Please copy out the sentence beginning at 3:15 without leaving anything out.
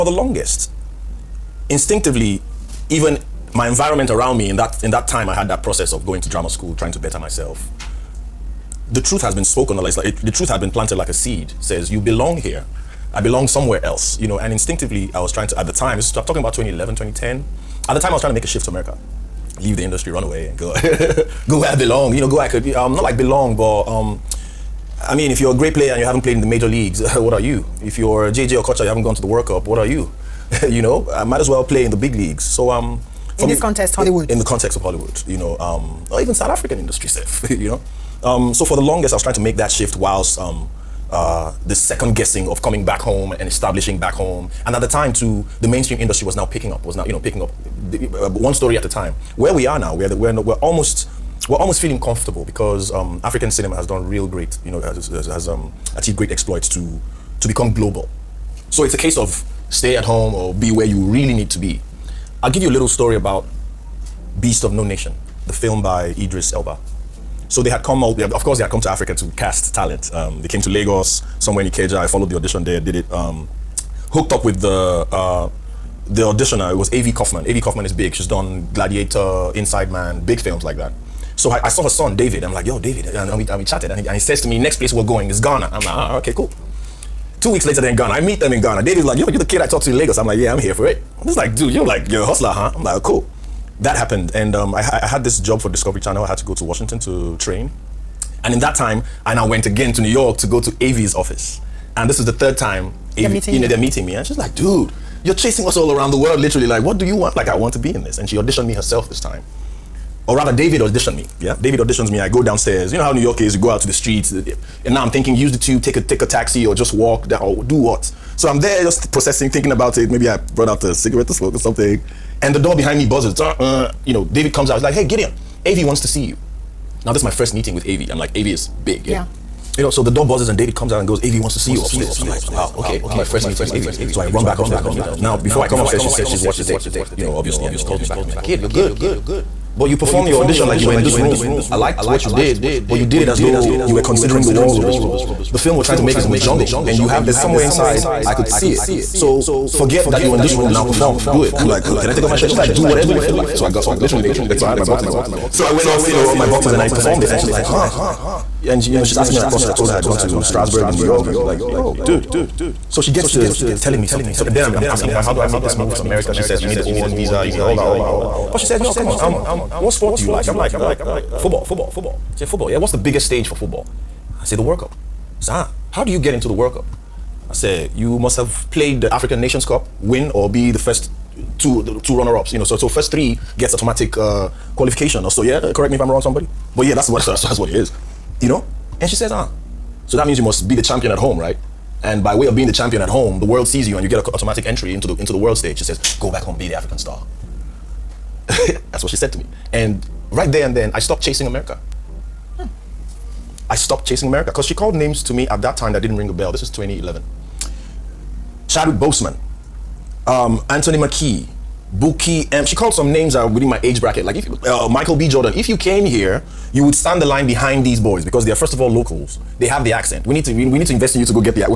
She says, go back home, be the African star.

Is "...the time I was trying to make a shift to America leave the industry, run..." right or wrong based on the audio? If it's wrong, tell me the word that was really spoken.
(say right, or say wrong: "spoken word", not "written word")
right.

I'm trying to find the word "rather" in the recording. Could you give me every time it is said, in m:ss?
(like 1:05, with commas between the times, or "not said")
1:50.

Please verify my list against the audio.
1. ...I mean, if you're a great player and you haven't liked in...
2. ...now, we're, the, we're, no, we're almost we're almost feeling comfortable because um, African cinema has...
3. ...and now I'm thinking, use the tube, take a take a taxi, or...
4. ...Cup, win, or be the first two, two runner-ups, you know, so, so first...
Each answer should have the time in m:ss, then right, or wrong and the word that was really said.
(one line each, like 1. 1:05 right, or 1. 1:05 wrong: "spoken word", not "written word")
1. 0:25 wrong: "played", not "liked"
2. 0:49 right
3. 1:54 right
4. 2:59 right.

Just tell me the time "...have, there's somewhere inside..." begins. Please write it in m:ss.
2:27.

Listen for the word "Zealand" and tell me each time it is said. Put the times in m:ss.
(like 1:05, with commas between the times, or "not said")
not said.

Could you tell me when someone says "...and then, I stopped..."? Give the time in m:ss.
3:20.